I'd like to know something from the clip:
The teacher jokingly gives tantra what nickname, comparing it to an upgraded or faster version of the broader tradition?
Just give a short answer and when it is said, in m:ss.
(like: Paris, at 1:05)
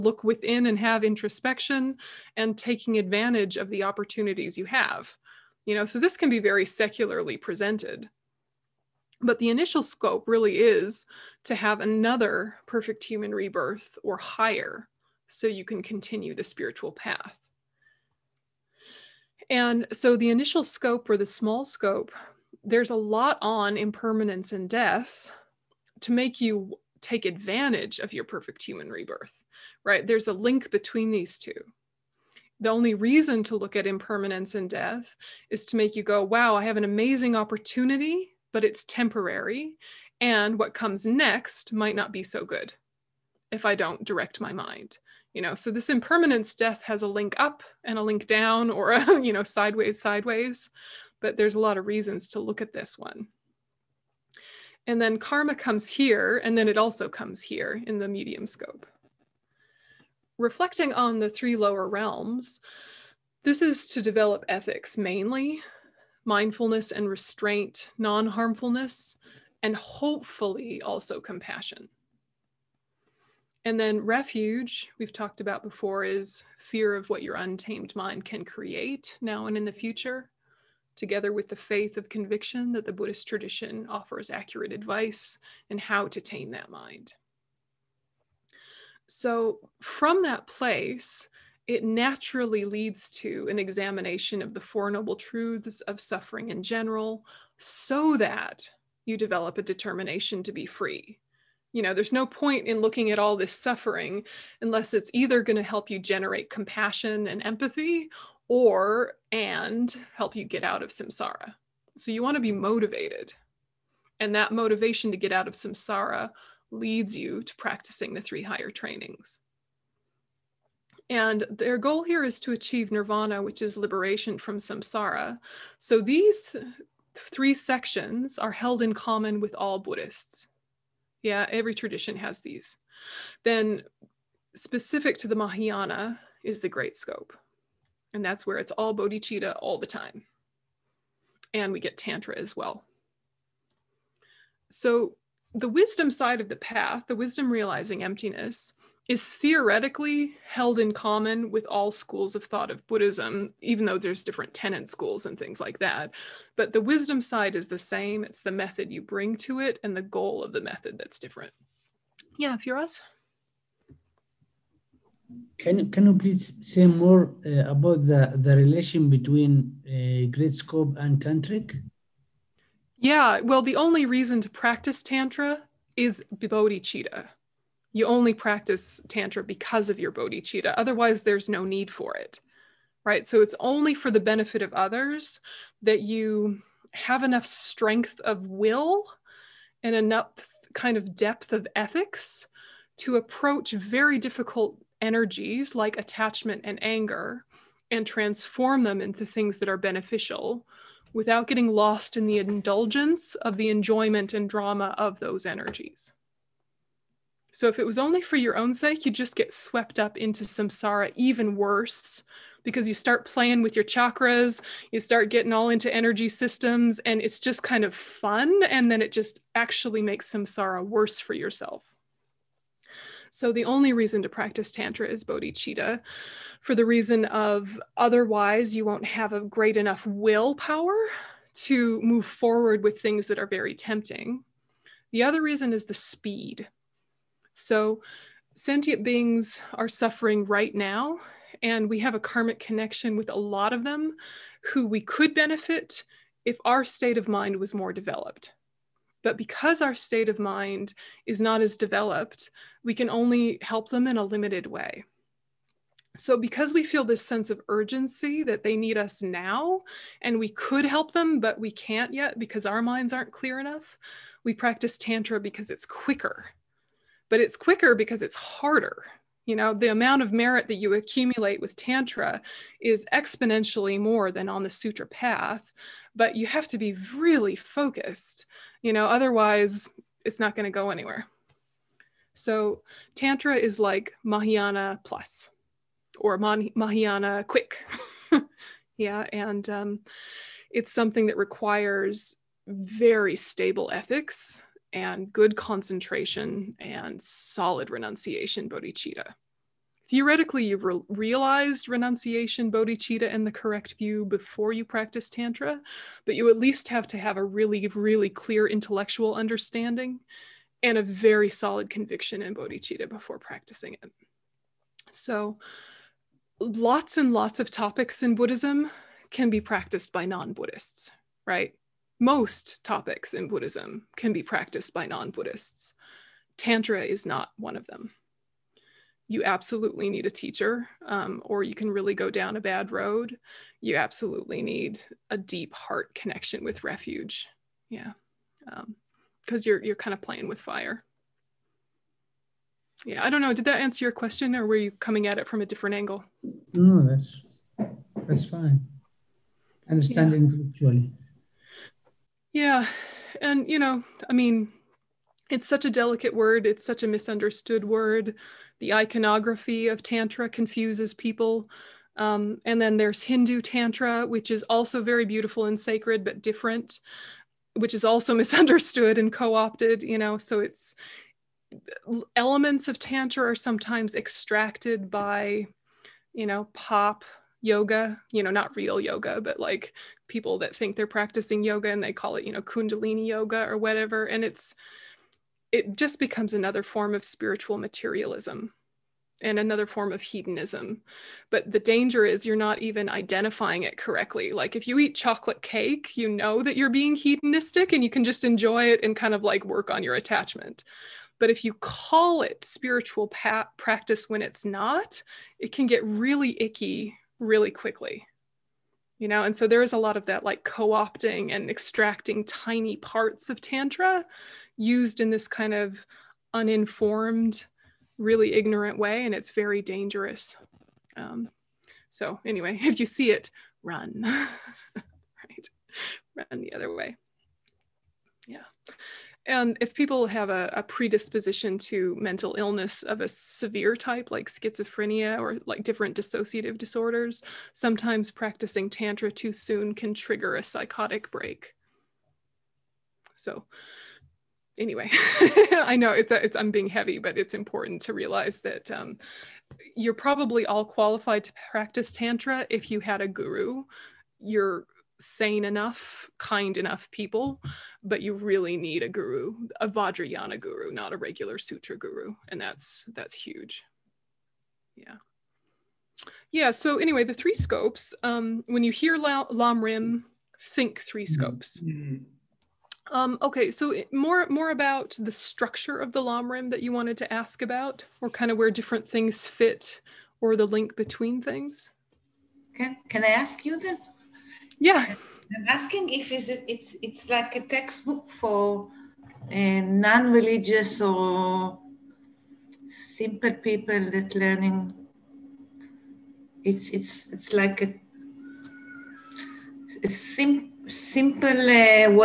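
Mahayana plus, at 4:44.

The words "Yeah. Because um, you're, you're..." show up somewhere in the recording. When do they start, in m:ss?
5:37.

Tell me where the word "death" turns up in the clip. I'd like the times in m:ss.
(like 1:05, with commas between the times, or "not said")
0:24, 0:34, 0:46.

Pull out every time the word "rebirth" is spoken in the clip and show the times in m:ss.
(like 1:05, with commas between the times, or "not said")
0:13, 0:28.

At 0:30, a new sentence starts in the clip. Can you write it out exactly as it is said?
There's a link between these two.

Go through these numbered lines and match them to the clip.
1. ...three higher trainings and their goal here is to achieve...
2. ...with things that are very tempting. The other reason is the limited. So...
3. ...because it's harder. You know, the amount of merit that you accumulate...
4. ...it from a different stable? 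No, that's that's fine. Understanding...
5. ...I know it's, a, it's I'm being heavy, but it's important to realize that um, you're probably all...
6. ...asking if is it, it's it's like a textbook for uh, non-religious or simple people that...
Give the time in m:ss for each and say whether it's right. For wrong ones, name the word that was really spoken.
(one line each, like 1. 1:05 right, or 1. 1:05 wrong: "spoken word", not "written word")
1. 1:58 right
2. 3:52 wrong: "speed", not "limited"
3. 4:27 right
4. 5:45 wrong: "angle", not "stable"
5. 7:25 right
6. 8:05 right.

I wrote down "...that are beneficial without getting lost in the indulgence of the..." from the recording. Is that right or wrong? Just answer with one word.
right.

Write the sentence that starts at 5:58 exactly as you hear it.
The iconography of Tantra confuses people.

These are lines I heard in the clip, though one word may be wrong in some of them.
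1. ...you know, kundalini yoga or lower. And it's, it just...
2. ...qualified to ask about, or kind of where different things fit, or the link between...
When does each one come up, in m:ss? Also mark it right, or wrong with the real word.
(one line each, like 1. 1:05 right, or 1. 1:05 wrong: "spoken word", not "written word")
1. 6:22 wrong: "whatever", not "lower"
2. 7:56 wrong: "wanted", not "qualified".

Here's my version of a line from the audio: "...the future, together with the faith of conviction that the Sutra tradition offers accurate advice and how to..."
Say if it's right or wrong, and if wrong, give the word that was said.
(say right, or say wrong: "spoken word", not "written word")
wrong: "Buddhist", not "Sutra".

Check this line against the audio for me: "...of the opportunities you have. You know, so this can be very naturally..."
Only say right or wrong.
wrong.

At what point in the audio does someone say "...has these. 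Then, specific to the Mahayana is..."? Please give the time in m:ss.
2:12.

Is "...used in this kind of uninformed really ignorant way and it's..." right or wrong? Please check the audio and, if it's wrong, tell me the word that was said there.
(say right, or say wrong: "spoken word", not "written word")
right.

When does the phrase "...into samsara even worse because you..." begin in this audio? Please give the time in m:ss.
3:30.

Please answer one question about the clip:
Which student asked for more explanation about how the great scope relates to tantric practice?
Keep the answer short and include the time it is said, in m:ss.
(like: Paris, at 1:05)
Firas, at 2:42.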